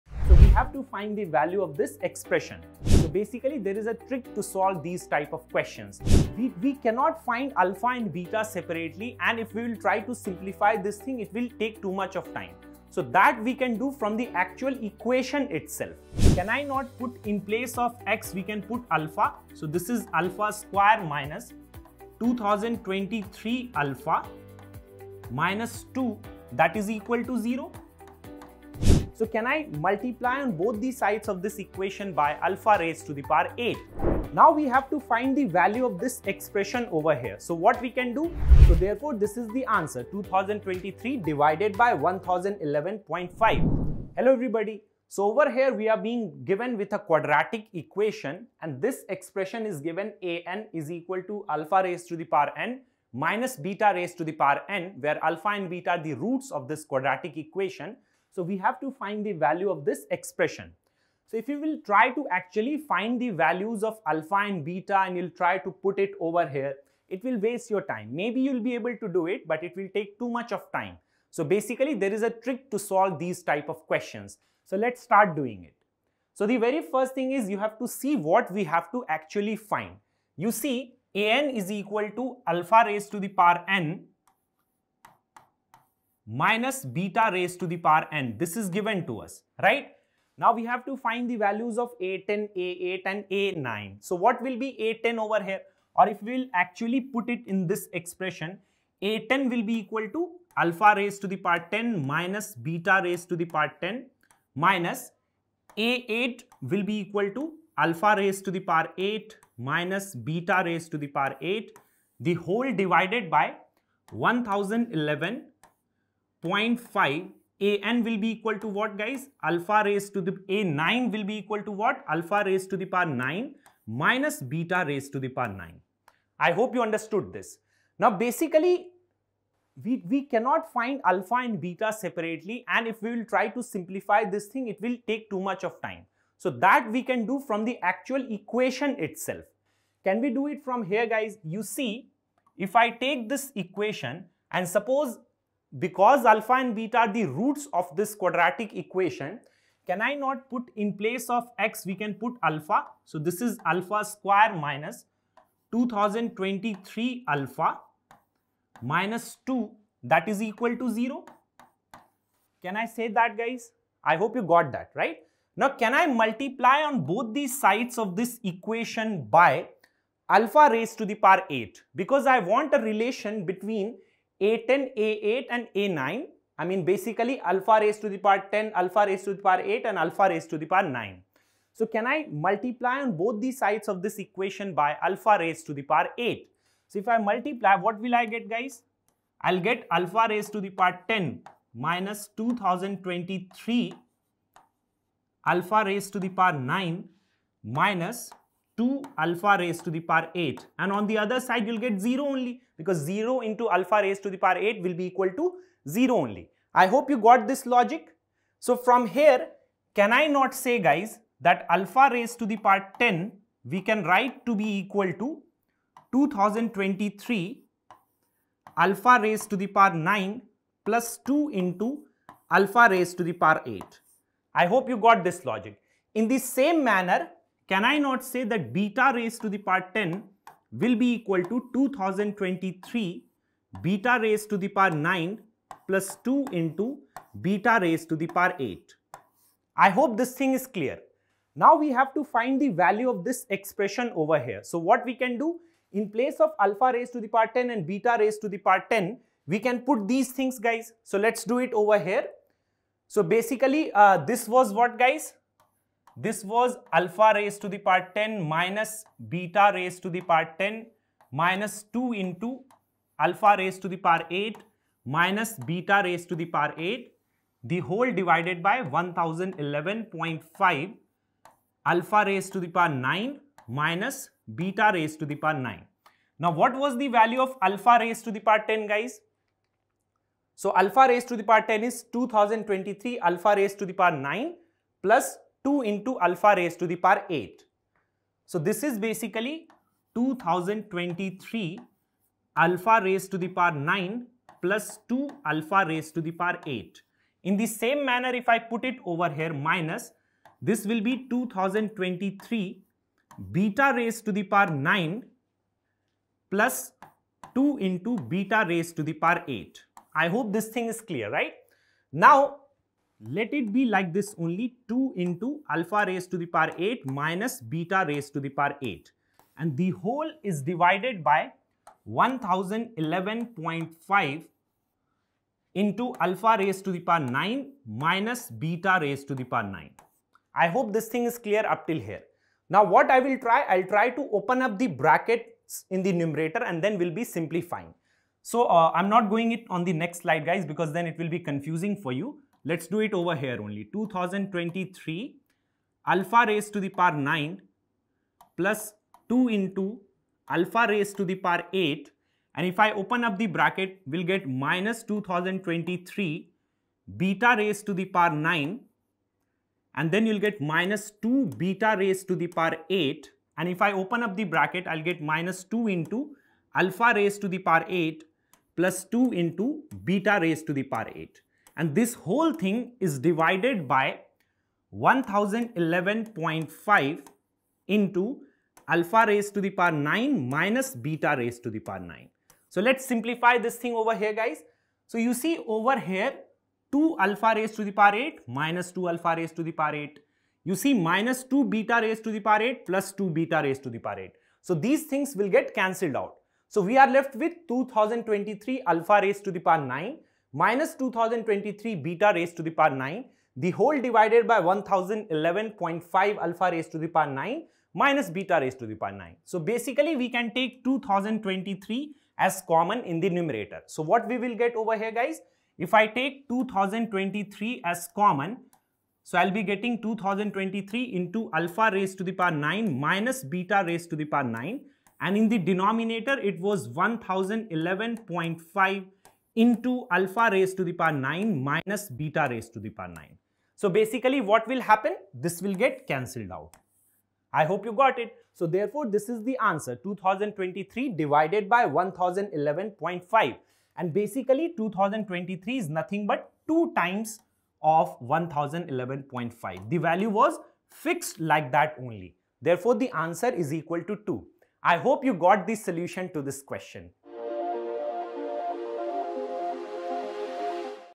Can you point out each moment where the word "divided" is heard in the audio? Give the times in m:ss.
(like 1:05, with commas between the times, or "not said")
0:41, 1:52, 4:28, 5:20, 6:13, 6:44, 7:21.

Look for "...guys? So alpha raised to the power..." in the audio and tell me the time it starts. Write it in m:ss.
4:38.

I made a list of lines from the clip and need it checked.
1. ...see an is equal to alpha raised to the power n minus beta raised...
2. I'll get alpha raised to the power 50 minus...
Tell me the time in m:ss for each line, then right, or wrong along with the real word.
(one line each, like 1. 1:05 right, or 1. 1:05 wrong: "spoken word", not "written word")
1. 1:20 right
2. 3:09 wrong: "10", not "50".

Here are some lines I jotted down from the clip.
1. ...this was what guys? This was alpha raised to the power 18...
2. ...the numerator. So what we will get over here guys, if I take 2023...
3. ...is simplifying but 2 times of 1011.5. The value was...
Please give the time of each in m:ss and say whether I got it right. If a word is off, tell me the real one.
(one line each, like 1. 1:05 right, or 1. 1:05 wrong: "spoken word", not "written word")
1. 4:14 wrong: "10", not "18"
2. 6:53 right
3. 7:25 wrong: "nothing", not "simplifying".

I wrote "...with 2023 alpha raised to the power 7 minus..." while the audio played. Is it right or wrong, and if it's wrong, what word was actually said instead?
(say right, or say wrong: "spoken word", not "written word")
wrong: "9", not "7".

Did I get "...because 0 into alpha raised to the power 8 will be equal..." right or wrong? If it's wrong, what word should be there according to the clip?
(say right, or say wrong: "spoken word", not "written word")
right.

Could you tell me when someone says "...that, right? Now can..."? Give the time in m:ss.
2:44.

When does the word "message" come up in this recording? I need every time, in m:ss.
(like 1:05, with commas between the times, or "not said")
not said.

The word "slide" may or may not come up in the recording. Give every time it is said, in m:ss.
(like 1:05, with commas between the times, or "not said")
5:40.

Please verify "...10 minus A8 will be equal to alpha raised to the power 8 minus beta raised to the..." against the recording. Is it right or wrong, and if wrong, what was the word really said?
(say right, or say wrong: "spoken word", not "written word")
right.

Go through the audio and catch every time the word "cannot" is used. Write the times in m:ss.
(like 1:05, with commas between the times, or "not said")
0:06, 2:10.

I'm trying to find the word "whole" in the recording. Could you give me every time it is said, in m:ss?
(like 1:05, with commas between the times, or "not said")
1:52, 4:27, 5:19, 6:12, 6:43.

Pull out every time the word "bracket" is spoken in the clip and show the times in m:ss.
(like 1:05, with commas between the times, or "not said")
5:34, 5:53, 6:04.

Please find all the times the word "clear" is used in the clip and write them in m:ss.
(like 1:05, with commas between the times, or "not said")
4:00, 5:11, 5:31.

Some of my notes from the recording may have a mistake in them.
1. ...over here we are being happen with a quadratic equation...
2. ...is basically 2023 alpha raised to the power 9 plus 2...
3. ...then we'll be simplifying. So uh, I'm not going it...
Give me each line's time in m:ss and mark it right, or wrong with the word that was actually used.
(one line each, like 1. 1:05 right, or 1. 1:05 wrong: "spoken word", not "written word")
1. 0:45 wrong: "given", not "happen"
2. 4:48 right
3. 5:36 right.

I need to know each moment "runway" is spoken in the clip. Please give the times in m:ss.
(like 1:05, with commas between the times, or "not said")
not said.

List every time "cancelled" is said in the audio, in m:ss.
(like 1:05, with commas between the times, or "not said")
6:35, 7:16.